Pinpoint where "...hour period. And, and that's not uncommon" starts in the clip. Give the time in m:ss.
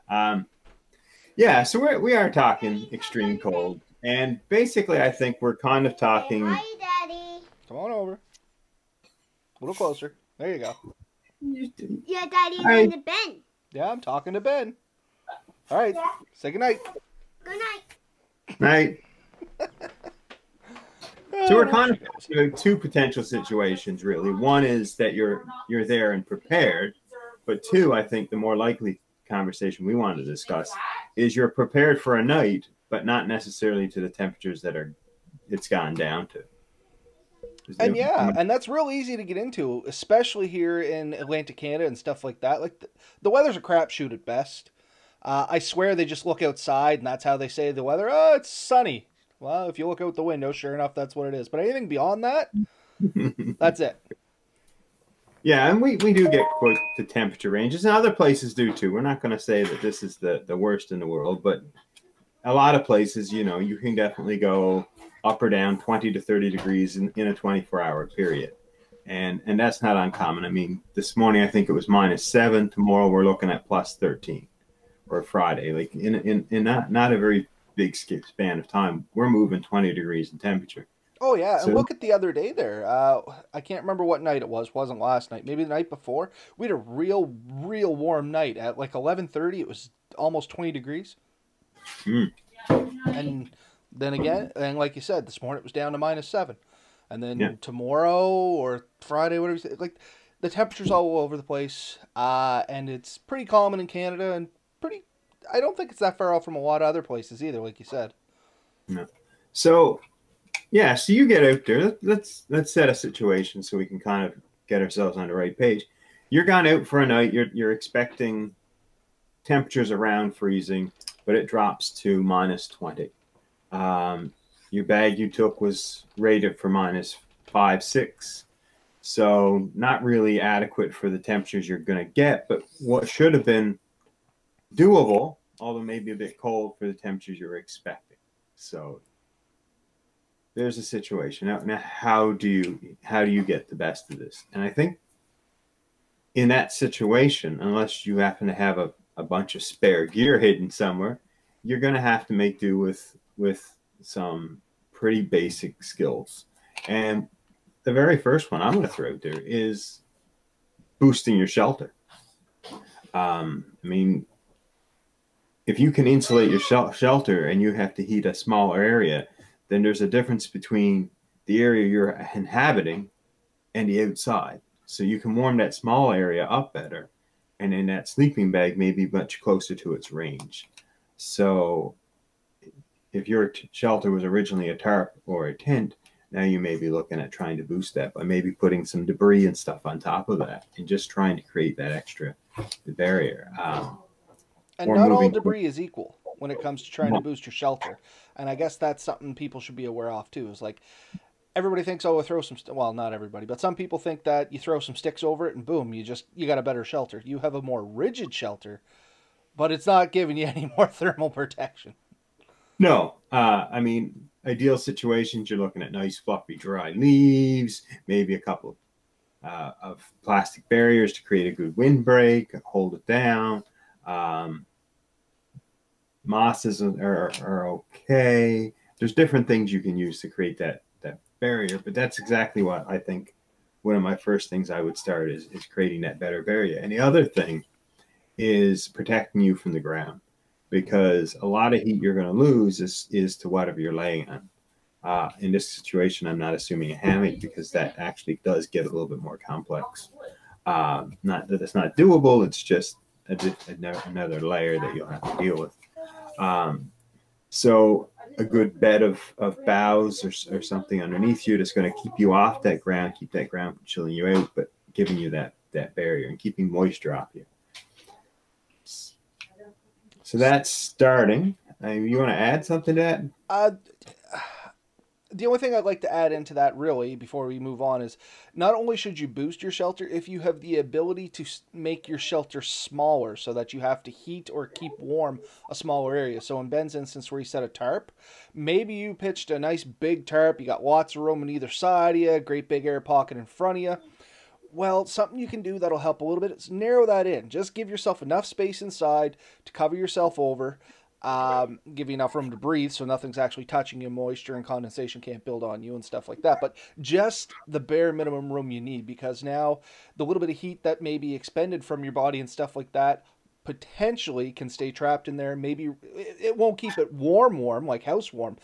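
1:07.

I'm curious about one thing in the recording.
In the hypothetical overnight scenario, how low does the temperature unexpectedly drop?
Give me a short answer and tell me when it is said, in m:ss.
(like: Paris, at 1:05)
-20, at 2:02.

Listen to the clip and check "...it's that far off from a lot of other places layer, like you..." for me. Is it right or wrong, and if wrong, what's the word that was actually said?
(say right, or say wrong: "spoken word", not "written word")
wrong: "either", not "layer".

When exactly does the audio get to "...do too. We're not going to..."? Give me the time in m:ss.
0:58.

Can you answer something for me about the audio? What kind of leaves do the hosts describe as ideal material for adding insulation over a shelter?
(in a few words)
Fluffy, dry leaves.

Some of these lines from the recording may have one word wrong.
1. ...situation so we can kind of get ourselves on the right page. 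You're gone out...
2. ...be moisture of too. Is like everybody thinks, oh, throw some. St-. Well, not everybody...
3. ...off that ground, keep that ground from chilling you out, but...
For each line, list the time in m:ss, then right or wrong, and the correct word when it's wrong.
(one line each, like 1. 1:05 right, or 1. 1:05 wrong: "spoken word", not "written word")
1. 1:52 right
2. 3:19 wrong: "aware", not "moisture"
3. 4:22 right.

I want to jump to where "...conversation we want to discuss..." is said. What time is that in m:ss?
0:29.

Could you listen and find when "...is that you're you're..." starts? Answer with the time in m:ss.
0:24.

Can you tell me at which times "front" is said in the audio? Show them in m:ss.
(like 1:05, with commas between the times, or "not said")
4:53.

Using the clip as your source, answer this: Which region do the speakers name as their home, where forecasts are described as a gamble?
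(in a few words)
Atlantic Canada.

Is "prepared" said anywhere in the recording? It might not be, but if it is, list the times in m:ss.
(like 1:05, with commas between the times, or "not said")
0:26, 0:31.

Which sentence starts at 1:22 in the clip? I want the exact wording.
Uh, I can't remember what night it was.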